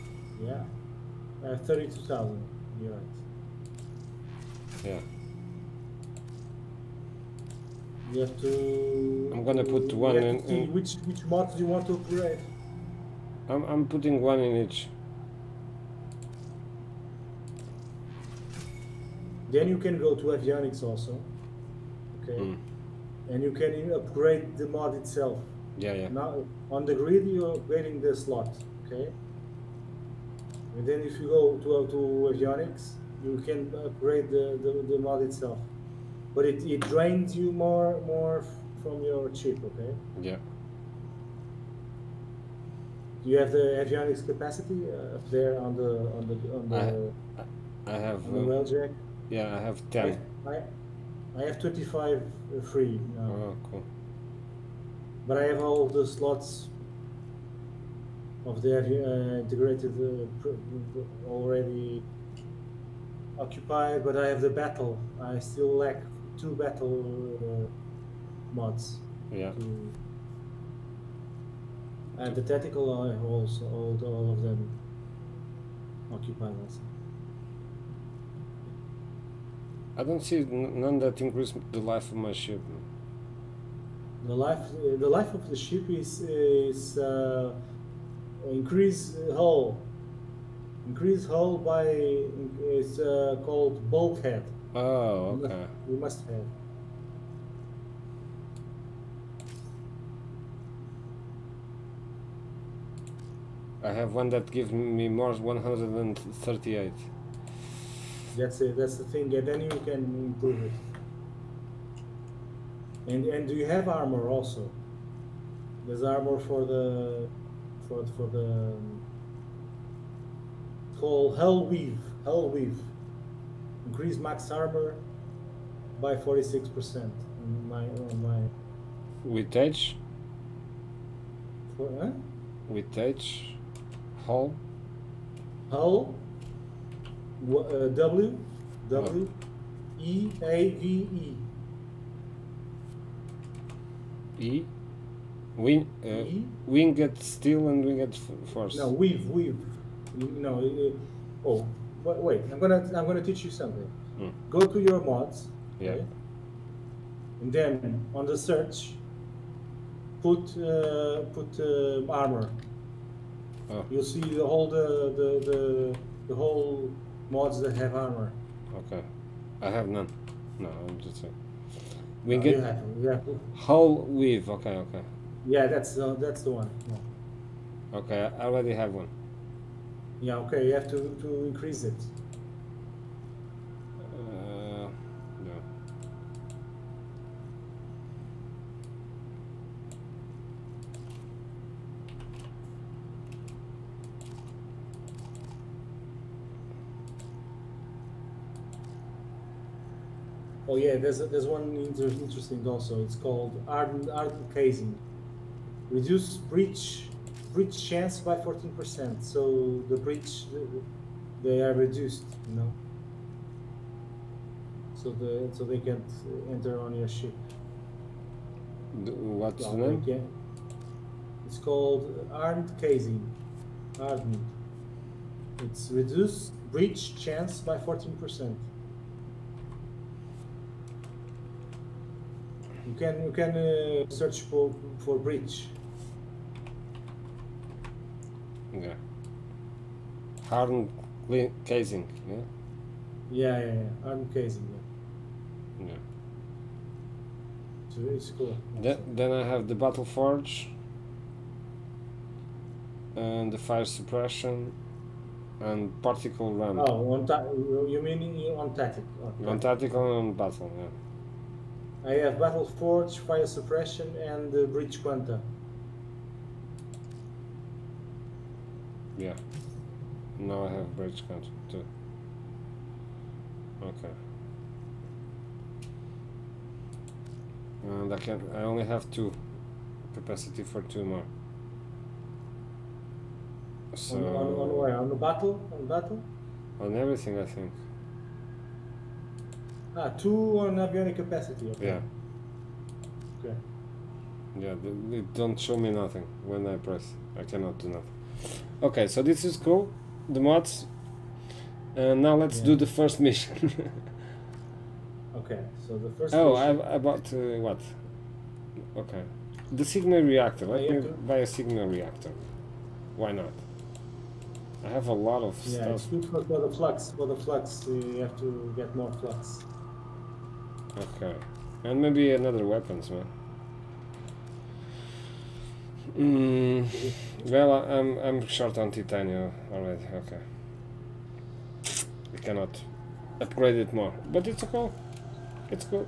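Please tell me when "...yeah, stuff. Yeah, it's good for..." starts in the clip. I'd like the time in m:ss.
5:15.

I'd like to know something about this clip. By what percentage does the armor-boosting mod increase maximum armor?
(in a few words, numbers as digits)
46%.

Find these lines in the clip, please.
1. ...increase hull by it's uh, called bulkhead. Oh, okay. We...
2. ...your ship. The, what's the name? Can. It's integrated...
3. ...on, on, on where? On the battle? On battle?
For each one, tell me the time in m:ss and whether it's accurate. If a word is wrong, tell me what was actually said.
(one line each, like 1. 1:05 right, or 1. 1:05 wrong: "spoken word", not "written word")
1. 1:30 right
2. 3:36 wrong: "called", not "integrated"
3. 4:44 right.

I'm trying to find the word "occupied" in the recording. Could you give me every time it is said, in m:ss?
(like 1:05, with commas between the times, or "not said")
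1:03, 1:16.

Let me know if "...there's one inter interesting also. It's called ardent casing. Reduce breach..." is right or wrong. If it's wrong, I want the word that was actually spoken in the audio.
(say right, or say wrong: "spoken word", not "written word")
right.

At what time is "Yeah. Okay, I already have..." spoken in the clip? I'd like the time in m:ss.
2:56.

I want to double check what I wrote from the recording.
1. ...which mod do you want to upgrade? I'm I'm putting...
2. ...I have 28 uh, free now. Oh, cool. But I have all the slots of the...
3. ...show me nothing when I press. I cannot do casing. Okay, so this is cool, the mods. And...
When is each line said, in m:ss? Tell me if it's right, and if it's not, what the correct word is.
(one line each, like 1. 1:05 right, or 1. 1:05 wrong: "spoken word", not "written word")
1. 0:11 right
2. 0:51 wrong: "25", not "28"
3. 4:55 wrong: "nothing", not "casing".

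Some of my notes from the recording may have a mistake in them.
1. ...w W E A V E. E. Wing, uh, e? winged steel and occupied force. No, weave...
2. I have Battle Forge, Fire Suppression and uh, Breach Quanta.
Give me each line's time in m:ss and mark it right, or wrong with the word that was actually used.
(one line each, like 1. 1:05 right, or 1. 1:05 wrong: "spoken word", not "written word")
1. 2:17 wrong: "winged", not "occupied"
2. 4:22 right.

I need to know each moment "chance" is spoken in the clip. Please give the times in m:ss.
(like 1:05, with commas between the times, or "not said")
3:27, 3:47.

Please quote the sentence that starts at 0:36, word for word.
But it, it drains you more more from your chip, okay?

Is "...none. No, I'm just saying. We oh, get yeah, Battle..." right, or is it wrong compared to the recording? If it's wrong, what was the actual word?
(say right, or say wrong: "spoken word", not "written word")
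wrong: "Hull", not "Battle".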